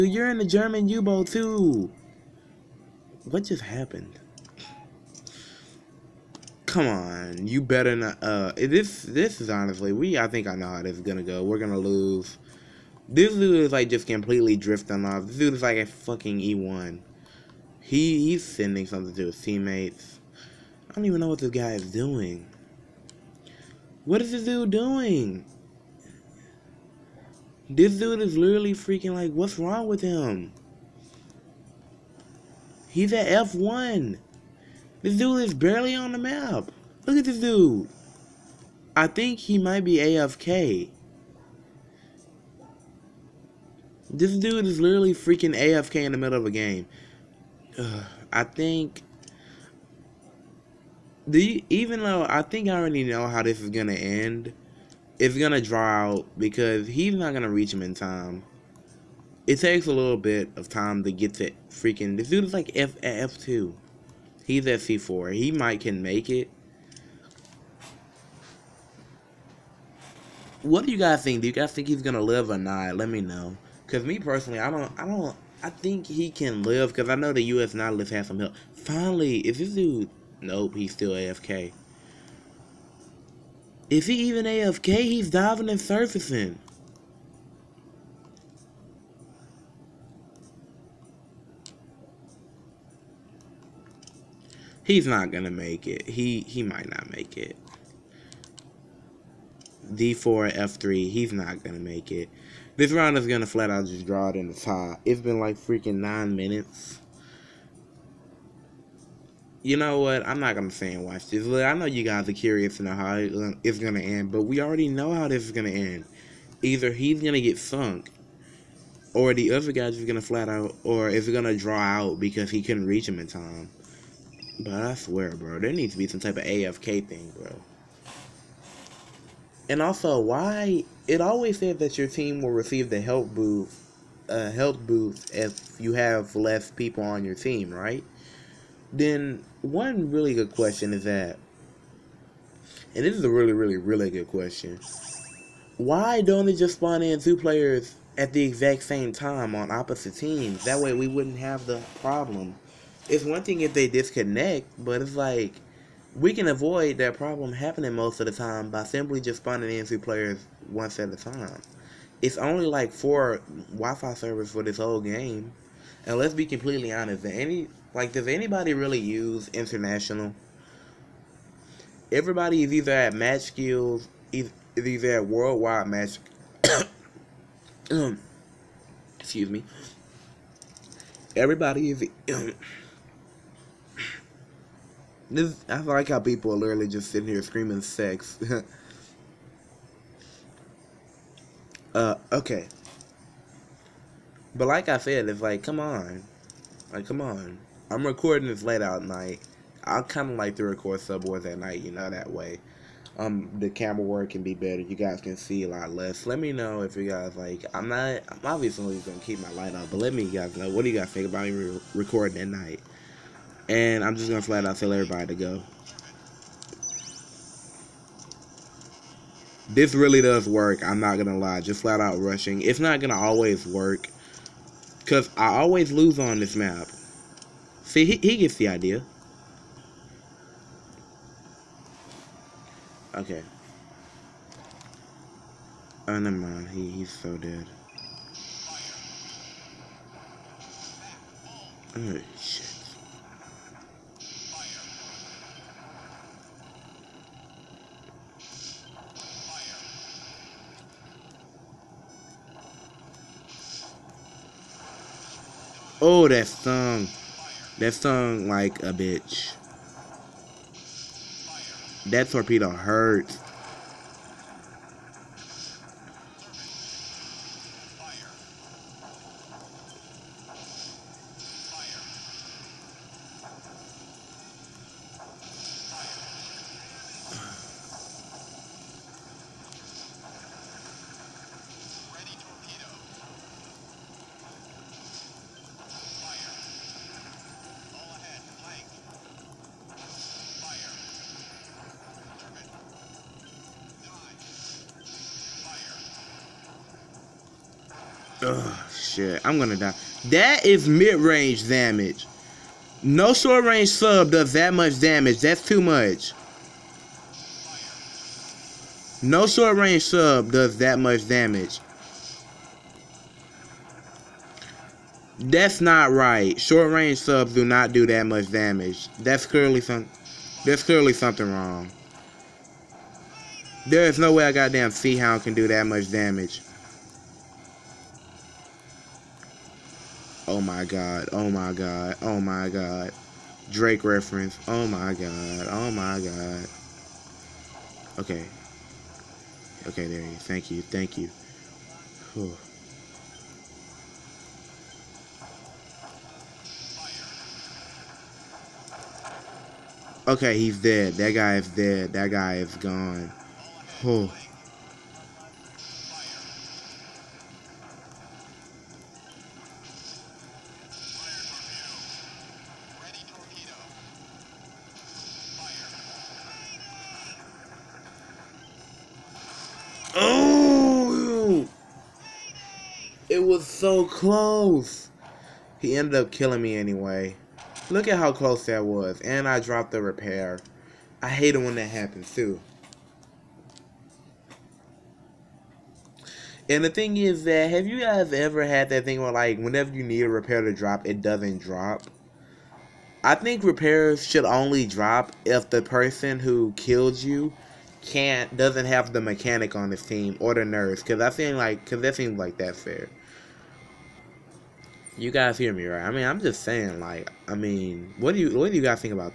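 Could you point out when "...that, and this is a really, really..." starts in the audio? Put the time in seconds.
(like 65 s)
141 s.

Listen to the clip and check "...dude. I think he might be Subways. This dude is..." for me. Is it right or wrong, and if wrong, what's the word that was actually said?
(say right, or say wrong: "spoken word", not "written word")
wrong: "AFK", not "Subways".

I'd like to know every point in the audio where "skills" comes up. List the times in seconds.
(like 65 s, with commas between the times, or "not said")
173 s.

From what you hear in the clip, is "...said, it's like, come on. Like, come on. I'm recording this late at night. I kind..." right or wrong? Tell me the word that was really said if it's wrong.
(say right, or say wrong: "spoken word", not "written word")
right.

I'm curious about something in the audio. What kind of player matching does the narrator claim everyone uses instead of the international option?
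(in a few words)
worldwide match.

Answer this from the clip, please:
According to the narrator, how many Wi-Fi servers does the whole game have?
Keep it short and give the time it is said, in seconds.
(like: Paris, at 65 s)
4, at 162 s.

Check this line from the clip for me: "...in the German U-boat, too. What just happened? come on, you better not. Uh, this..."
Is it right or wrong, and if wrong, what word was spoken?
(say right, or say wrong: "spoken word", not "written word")
right.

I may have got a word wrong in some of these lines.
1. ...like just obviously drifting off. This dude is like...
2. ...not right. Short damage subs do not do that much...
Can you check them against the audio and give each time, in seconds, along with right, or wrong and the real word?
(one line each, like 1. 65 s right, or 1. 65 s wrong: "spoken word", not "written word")
1. 13 s wrong: "completely", not "obviously"
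2. 315 s wrong: "range", not "damage".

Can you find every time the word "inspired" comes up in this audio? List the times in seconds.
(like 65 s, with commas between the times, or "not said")
not said.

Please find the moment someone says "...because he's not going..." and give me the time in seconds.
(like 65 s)
56 s.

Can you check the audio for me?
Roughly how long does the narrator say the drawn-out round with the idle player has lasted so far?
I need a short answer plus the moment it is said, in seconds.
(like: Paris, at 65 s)
9 minutes, at 105 s.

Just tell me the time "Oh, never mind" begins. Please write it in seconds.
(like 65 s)
236 s.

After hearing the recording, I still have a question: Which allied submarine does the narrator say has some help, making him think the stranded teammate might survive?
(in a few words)
U.S. Nautilus.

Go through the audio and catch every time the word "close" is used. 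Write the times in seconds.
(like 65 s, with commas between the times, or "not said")
374 s, 378 s.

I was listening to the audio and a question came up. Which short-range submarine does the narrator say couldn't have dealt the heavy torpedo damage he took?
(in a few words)
Seahound.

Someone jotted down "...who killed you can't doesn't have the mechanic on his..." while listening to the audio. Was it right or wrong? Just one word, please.
right.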